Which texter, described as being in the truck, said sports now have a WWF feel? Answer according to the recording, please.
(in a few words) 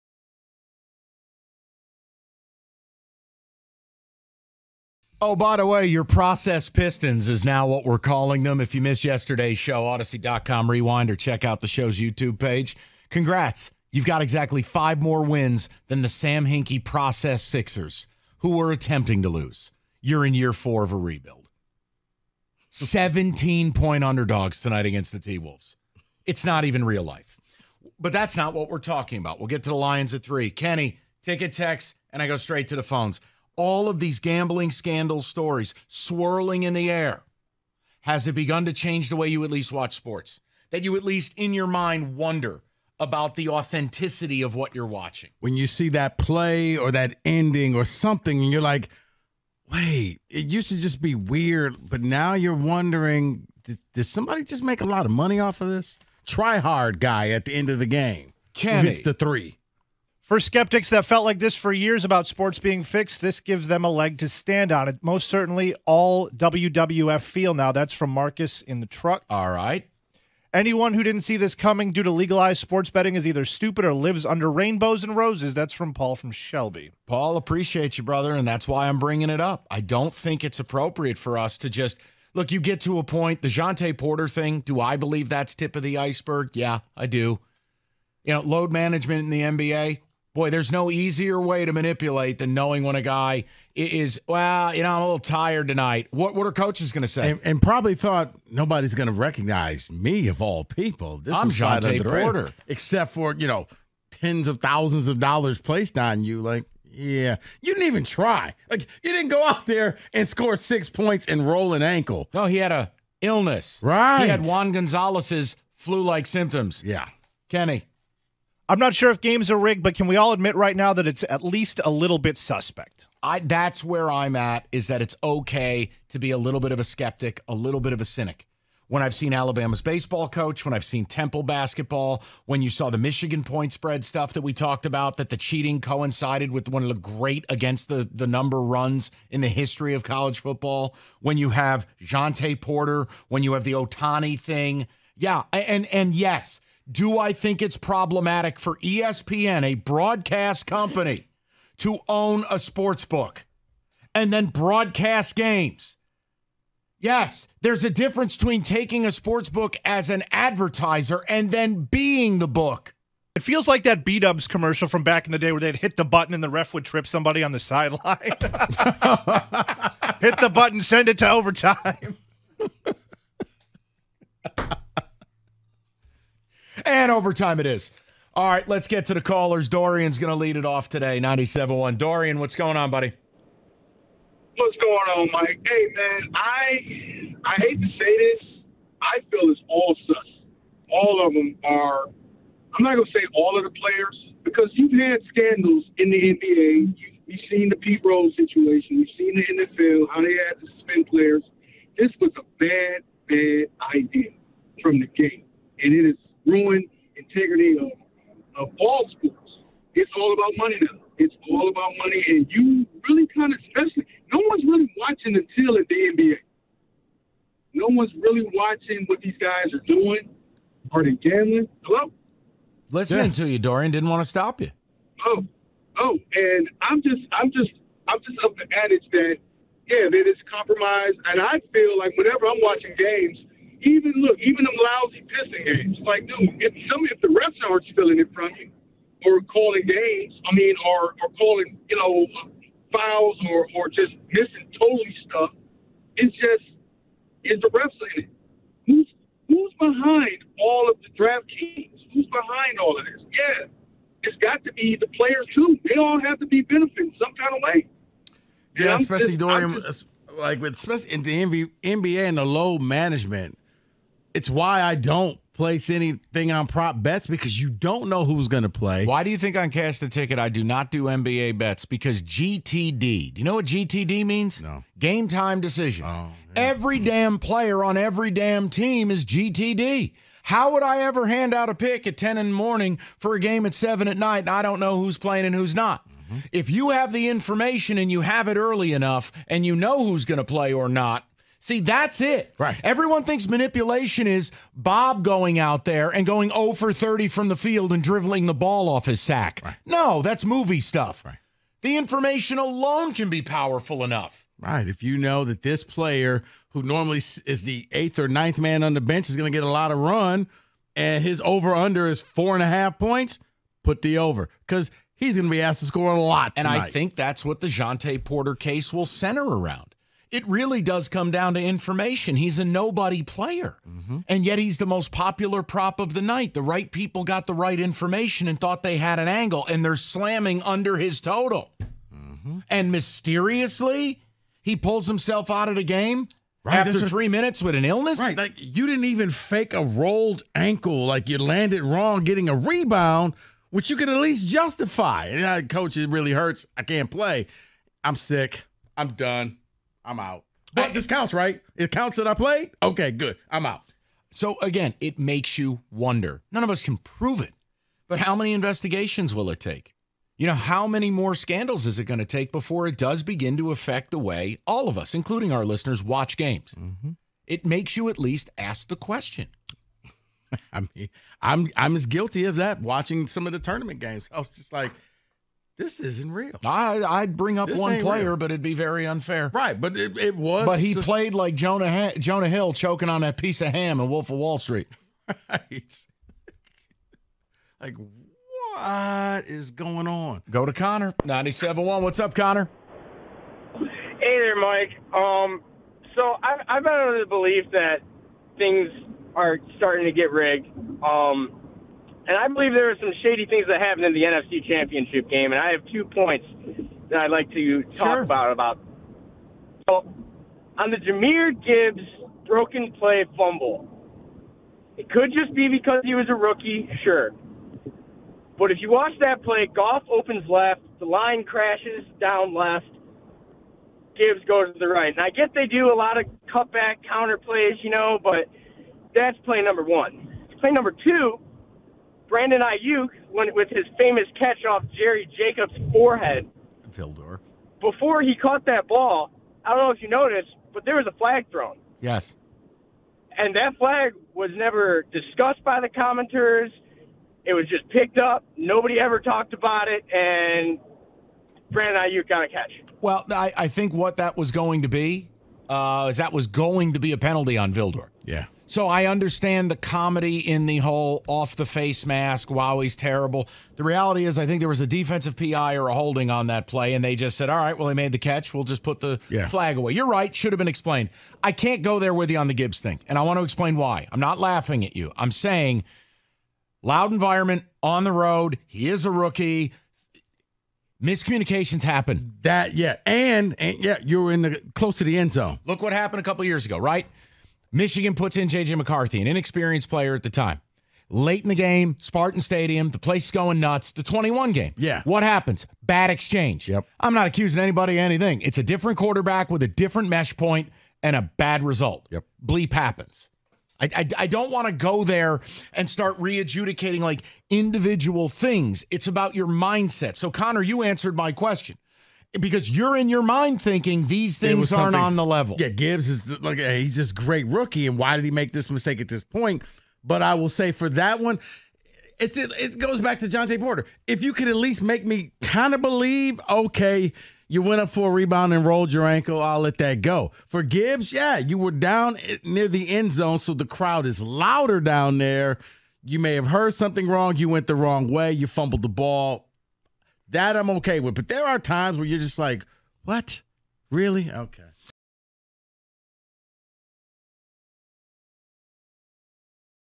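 Marcus.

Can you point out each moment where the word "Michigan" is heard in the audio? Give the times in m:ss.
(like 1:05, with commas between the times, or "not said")
2:12, 8:07.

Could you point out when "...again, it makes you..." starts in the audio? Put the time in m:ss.
5:54.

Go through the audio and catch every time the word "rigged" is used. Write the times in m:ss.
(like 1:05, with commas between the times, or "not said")
1:59, 6:40.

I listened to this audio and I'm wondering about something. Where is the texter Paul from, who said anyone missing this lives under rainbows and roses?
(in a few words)
Shelby.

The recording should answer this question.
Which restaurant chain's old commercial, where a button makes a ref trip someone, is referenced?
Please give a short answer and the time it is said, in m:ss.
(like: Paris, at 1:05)
B Dubs, at 2:44.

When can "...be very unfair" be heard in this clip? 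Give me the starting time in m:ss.
6:18.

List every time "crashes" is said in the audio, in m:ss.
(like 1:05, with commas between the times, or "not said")
7:01.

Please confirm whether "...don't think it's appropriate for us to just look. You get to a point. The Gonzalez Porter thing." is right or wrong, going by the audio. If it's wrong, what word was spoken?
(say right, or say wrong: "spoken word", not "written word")
wrong: "Jontay", not "Gonzalez".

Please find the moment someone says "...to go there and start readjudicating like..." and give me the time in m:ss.
8:24.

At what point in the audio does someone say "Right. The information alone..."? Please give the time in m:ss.
5:01.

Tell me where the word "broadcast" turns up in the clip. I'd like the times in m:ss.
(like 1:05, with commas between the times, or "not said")
2:29, 2:34.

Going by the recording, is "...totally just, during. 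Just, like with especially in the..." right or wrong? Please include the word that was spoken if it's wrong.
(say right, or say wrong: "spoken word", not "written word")
wrong: "especially", not "totally".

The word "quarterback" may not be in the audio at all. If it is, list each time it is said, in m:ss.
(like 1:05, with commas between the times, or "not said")
8:18.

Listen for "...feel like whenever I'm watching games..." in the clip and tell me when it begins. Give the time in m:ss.
3:51.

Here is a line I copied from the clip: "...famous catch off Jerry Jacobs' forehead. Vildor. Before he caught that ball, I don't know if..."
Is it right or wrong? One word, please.
right.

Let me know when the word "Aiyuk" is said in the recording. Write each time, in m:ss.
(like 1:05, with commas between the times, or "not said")
7:12, 7:32.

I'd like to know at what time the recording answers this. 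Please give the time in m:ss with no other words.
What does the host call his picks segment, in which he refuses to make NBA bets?
4:29.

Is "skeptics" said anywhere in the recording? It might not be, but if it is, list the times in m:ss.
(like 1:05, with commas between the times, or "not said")
1:00, 2:06.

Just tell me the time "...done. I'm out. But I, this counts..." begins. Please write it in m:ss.
5:49.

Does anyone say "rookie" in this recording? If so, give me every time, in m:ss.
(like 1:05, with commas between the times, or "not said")
6:56, 7:59, 8:37.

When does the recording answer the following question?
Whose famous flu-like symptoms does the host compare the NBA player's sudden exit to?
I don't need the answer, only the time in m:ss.
1:54.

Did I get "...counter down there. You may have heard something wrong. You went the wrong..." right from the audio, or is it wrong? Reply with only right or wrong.
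wrong.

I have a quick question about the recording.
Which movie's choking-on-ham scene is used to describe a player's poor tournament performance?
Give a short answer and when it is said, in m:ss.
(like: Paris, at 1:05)
Wolf of Wall Street, at 6:24.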